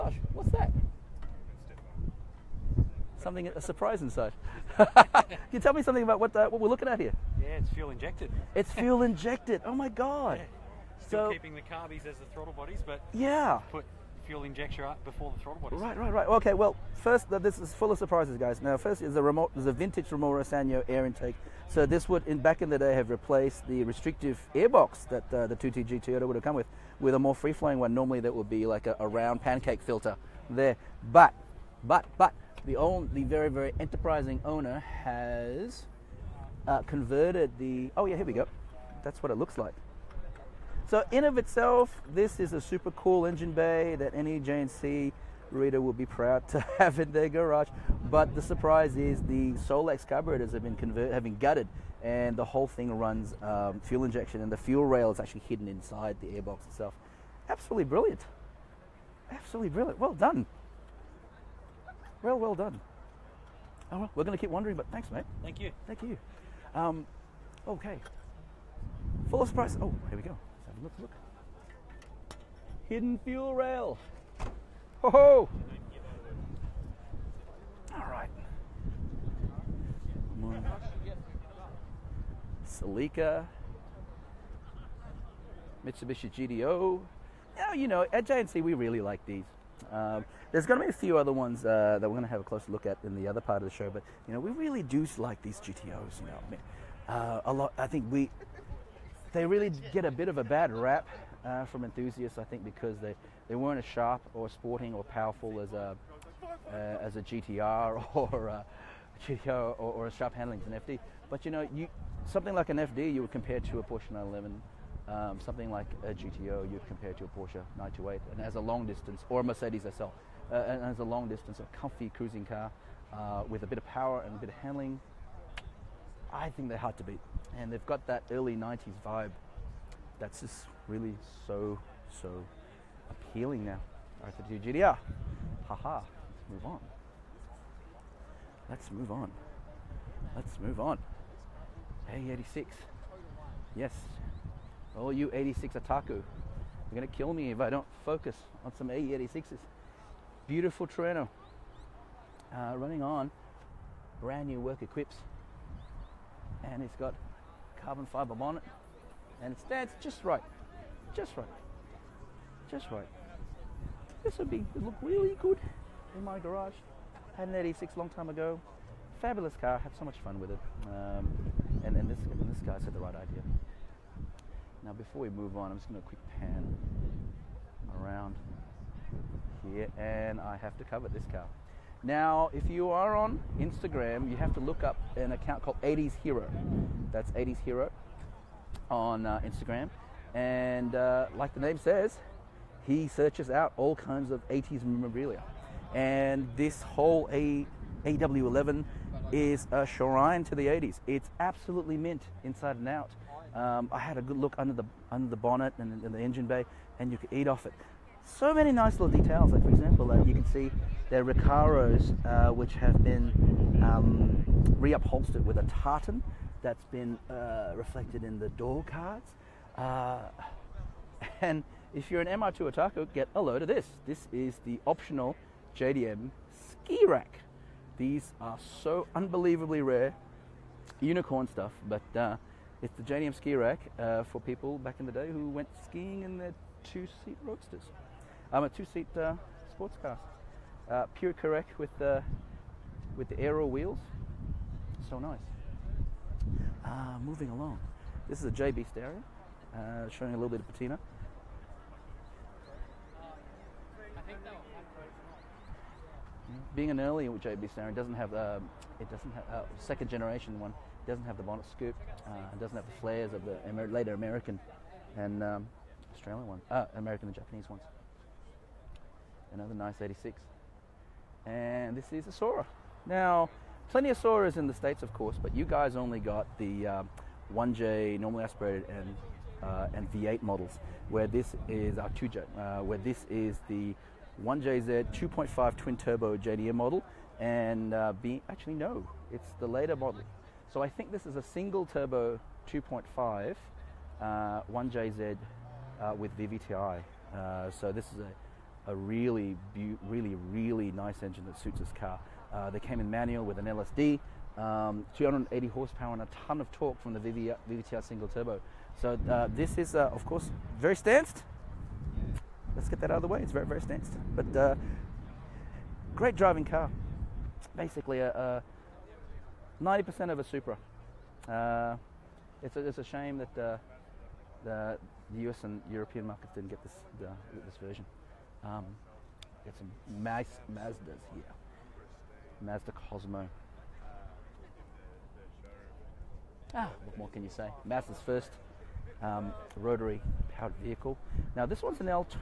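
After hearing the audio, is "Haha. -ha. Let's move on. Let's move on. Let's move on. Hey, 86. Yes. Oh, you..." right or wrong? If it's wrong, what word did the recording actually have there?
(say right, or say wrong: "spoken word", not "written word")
right.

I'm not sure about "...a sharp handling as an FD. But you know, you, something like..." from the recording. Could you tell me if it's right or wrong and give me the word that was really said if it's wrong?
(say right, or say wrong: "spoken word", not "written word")
right.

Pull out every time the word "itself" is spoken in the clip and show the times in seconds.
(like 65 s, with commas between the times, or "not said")
41 s, 56 s.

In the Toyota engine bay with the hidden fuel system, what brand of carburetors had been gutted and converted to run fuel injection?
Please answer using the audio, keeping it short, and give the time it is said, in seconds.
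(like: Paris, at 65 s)
Solex, at 49 s.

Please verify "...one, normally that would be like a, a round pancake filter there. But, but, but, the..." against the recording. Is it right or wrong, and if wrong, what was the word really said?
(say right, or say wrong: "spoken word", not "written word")
right.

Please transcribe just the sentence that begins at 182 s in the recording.
Now, if you are on Instagram, you have to look up an account called 80s Hero.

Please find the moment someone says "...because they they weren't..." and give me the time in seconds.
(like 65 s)
102 s.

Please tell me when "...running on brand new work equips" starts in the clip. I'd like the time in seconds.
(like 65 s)
152 s.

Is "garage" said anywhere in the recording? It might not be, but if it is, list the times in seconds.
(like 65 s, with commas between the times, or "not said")
47 s, 166 s.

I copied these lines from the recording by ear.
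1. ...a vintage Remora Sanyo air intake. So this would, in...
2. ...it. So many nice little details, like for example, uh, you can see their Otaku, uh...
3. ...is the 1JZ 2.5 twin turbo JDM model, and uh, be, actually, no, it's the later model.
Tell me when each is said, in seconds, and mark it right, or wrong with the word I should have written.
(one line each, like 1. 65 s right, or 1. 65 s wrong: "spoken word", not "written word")
1. 19 s right
2. 207 s wrong: "Recaros", not "Otaku"
3. 283 s right.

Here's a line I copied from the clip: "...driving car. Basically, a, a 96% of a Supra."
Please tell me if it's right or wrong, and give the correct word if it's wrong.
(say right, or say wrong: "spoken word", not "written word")
wrong: "90", not "96".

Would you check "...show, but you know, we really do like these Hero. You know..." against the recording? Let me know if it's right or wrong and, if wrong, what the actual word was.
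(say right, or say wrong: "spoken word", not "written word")
wrong: "GTOs", not "Hero".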